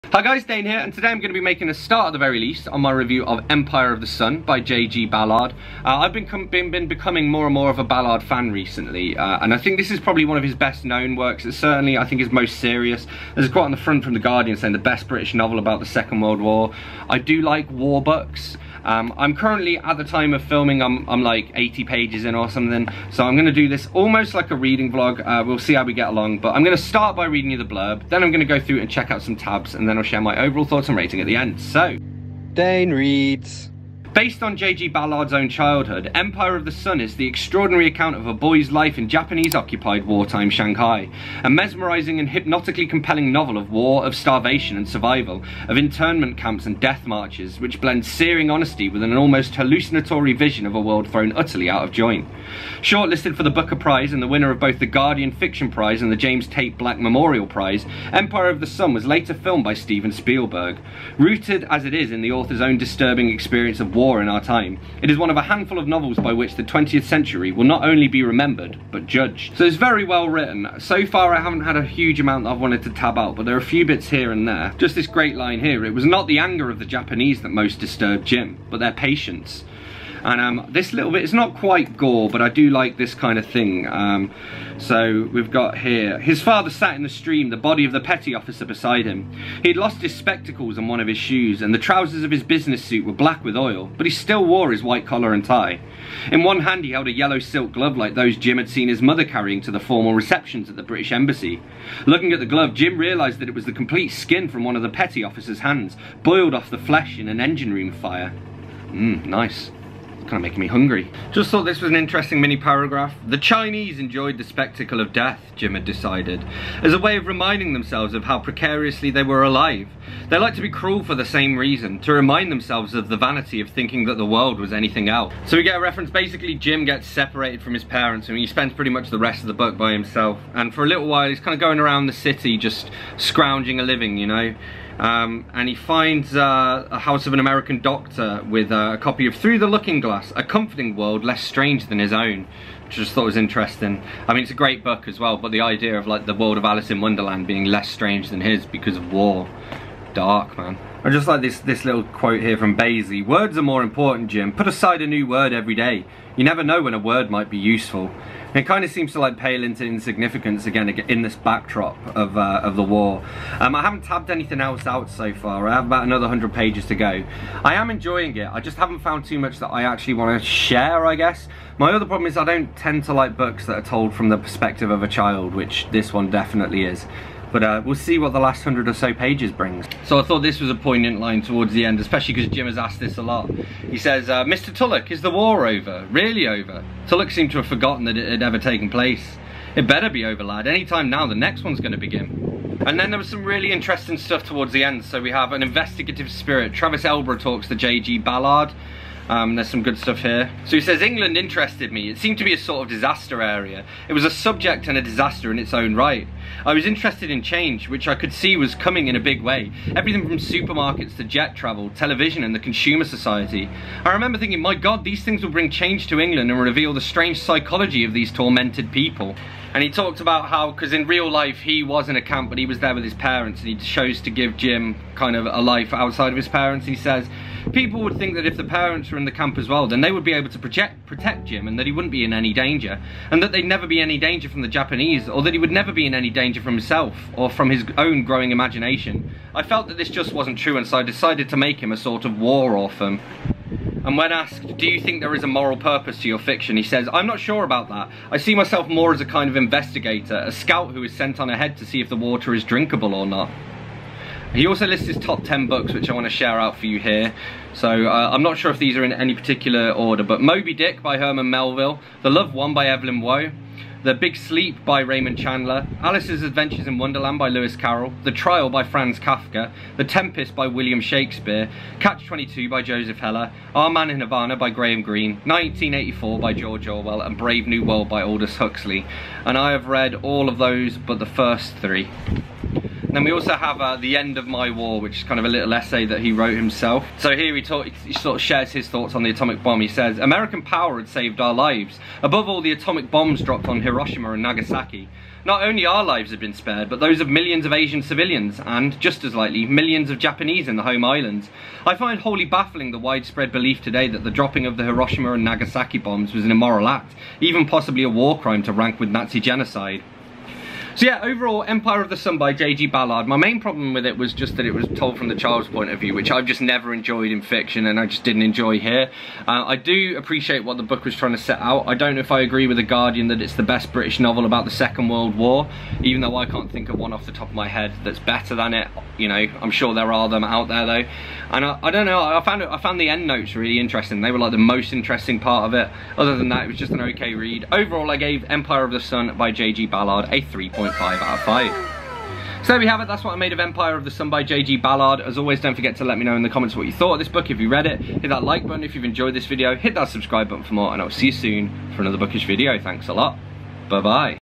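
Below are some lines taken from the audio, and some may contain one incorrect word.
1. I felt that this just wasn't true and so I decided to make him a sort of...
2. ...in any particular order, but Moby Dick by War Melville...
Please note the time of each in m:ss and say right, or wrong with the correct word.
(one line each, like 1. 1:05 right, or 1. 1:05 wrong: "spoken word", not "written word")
1. 3:59 right
2. 4:19 wrong: "Herman", not "War".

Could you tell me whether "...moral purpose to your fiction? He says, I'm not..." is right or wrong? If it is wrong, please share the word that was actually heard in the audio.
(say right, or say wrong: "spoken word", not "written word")
right.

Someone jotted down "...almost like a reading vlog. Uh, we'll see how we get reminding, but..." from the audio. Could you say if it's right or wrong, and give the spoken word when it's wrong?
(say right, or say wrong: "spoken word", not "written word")
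wrong: "along", not "reminding".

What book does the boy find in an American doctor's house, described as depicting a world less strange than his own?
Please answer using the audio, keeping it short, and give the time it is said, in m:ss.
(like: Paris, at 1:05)
Through the Looking Glass, at 2:19.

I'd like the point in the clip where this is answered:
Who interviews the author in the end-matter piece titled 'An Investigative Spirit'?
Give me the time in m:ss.
3:16.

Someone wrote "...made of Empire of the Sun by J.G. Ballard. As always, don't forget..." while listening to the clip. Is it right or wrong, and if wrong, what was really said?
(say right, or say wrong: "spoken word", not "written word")
right.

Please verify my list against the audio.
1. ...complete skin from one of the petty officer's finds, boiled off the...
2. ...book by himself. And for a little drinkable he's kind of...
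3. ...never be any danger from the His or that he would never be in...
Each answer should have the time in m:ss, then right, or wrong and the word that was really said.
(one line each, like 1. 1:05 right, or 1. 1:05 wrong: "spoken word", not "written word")
1. 1:43 wrong: "hands", not "finds"
2. 2:09 wrong: "while", not "drinkable"
3. 3:53 wrong: "Japanese", not "His".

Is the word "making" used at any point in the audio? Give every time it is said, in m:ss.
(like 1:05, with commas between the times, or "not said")
0:01, 1:50.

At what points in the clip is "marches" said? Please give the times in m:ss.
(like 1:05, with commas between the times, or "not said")
0:47.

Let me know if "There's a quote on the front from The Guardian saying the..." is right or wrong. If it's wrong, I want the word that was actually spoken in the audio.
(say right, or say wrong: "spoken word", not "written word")
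right.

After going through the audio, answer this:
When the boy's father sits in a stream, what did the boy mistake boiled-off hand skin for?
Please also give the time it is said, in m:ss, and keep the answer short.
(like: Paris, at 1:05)
A yellow silk glove, at 1:37.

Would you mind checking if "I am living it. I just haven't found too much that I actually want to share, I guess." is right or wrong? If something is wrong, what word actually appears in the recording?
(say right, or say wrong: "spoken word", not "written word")
wrong: "enjoying", not "living".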